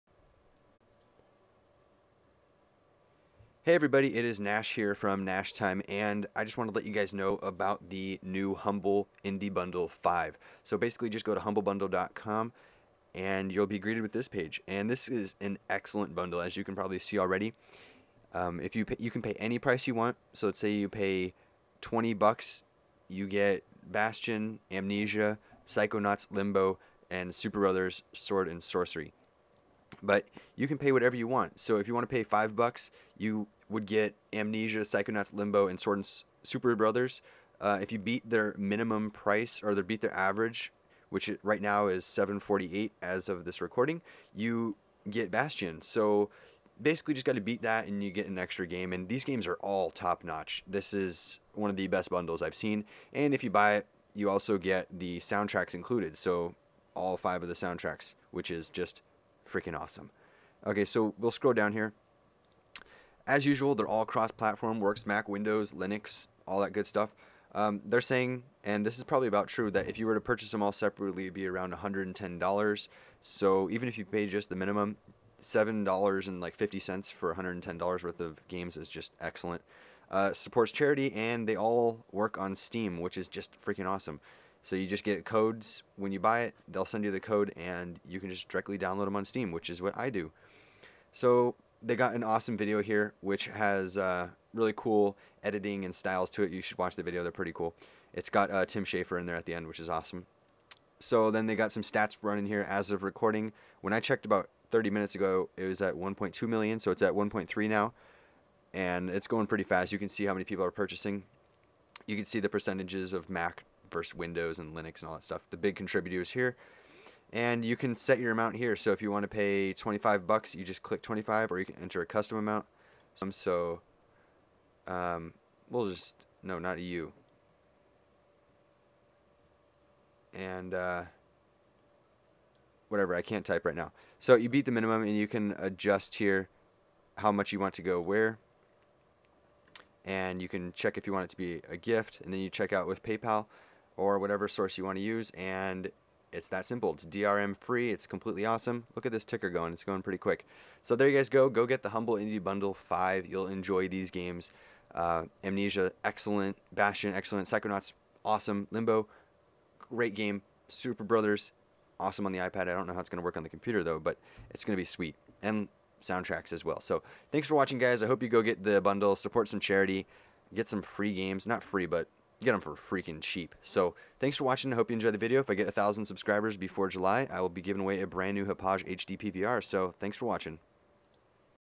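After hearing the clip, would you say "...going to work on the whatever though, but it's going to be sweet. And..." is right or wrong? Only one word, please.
wrong.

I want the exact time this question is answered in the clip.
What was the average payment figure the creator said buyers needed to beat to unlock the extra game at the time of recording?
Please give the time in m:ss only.
0:42.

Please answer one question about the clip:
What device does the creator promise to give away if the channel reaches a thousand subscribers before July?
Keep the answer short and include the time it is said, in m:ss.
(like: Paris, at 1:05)
Hauppauge HD PVR, at 2:58.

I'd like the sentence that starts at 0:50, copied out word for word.
This is one of the best bundles I've seen and if you buy it, you also get the soundtracks included.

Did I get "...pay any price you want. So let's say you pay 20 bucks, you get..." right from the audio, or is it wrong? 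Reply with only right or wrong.
right.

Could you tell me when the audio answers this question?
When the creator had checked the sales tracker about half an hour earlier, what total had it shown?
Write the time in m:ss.
1:45.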